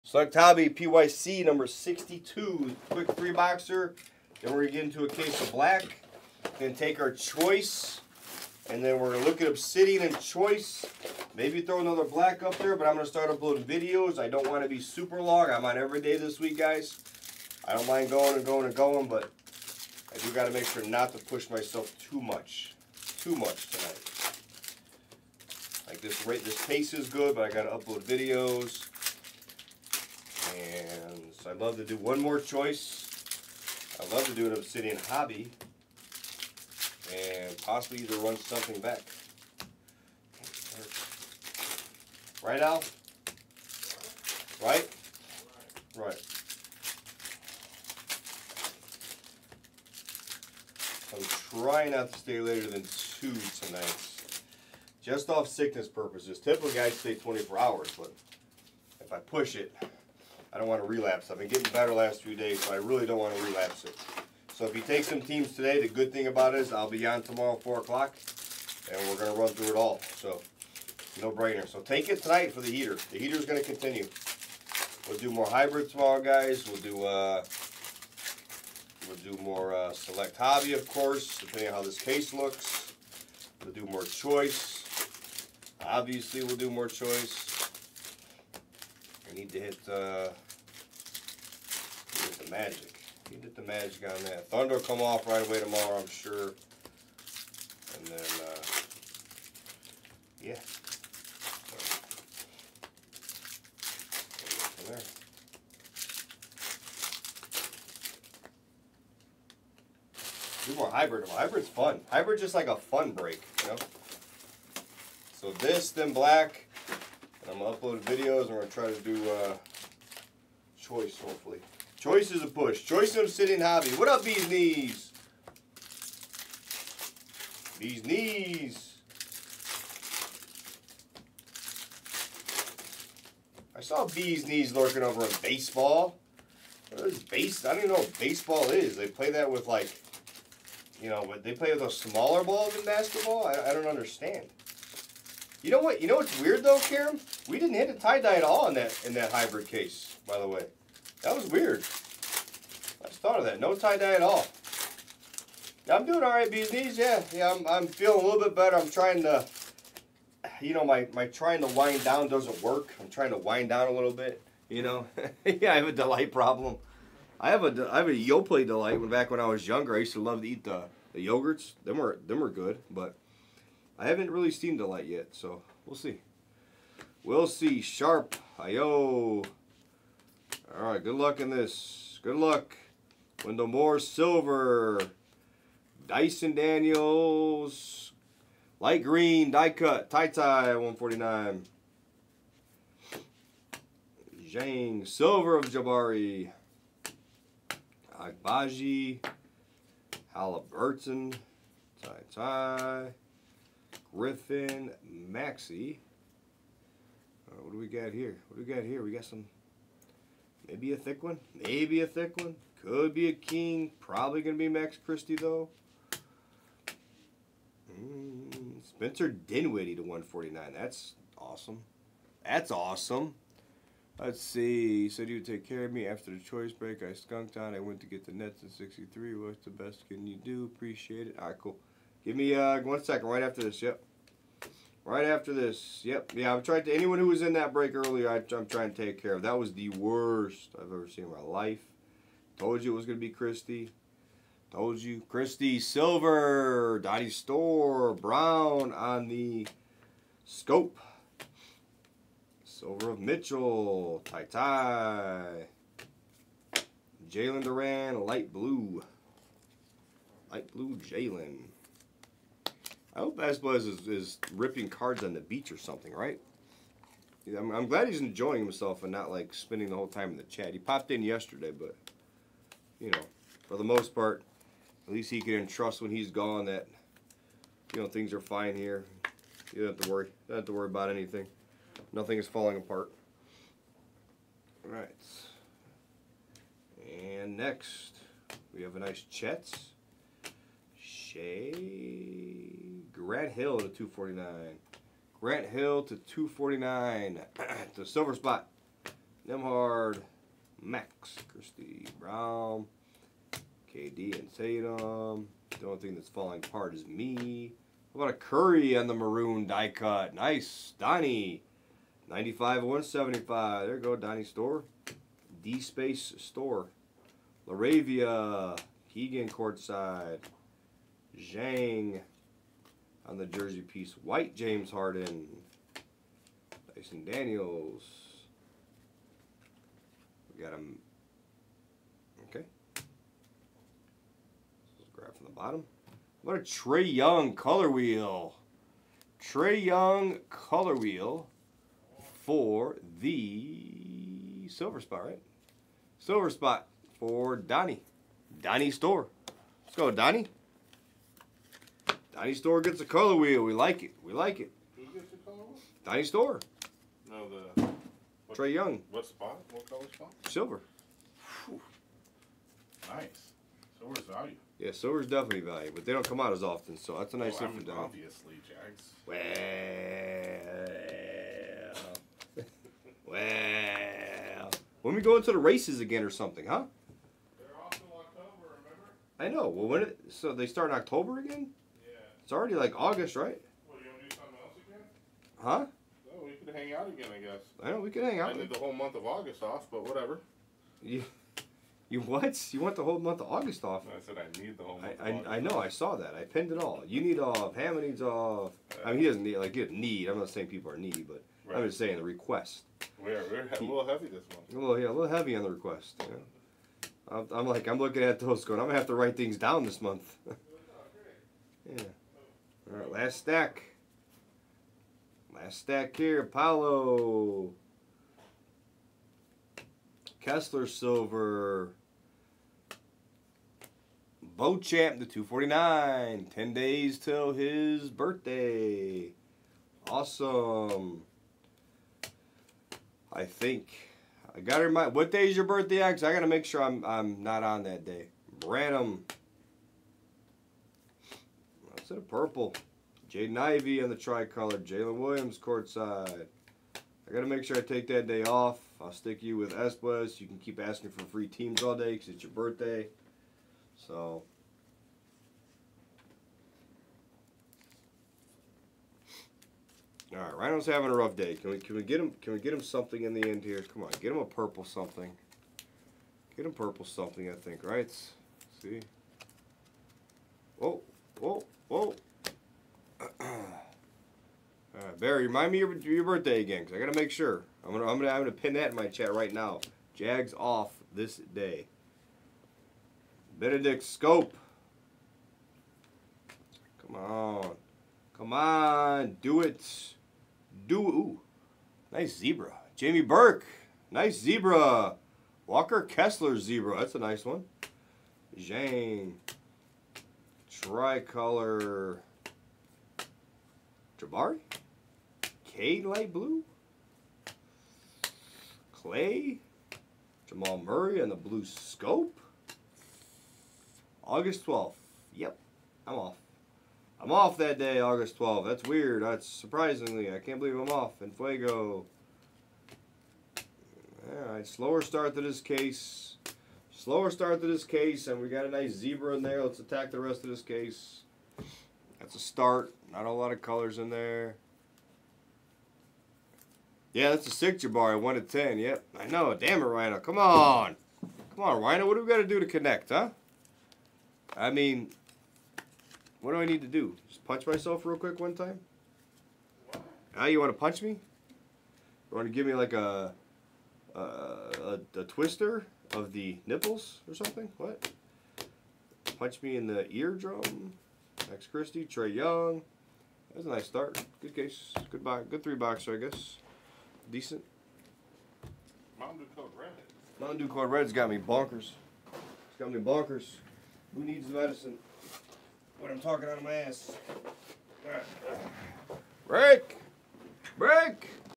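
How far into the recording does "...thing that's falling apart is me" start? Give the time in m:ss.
5:05.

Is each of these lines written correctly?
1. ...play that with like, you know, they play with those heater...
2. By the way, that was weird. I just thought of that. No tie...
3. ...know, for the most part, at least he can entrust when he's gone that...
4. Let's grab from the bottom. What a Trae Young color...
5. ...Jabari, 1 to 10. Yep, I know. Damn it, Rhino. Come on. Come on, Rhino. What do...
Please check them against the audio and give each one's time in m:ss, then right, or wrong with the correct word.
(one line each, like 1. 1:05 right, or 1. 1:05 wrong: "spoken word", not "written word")
1. 2:19 wrong: "smaller", not "heater"
2. 2:30 right
3. 4:33 right
4. 5:34 right
5. 8:57 right.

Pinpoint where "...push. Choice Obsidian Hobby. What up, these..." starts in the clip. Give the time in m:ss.
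2:02.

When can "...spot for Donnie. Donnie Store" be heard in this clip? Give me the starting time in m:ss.
5:46.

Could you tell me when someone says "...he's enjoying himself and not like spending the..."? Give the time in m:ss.
4:28.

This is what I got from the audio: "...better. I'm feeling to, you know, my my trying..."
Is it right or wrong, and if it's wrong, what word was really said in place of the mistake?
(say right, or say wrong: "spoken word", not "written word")
wrong: "trying", not "feeling".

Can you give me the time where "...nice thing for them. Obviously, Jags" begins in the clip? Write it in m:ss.
6:07.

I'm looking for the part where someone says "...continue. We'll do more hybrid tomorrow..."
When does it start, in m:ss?
1:13.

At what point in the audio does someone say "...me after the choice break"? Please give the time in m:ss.
3:45.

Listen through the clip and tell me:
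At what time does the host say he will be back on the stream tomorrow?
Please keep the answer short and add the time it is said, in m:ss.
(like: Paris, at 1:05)
4 o'clock, at 1:07.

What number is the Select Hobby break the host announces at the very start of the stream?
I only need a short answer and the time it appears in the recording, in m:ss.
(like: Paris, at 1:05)
62, at 0:01.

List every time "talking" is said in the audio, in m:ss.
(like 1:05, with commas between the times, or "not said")
9:36.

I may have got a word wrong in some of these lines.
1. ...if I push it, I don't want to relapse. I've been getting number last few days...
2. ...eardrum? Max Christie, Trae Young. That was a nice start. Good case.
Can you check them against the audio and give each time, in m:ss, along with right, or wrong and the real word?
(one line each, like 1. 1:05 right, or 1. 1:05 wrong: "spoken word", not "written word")
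1. 0:59 wrong: "better", not "number"
2. 9:20 right.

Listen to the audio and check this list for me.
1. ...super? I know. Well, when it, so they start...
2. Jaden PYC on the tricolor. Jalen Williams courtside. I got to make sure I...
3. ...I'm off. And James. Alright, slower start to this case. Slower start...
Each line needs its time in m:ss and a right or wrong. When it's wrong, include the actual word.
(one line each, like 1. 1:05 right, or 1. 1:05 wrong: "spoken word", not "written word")
1. 6:18 wrong: "remember", not "super"
2. 7:23 wrong: "Ivey", not "PYC"
3. 8:40 wrong: "Fuego", not "James".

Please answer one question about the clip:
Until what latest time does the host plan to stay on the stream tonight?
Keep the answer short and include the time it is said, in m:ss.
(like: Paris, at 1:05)
2, at 0:52.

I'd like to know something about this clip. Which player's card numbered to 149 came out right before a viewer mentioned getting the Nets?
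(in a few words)
Spencer Dinwiddie.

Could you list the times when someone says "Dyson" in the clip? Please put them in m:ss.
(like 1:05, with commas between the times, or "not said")
3:06, 5:26.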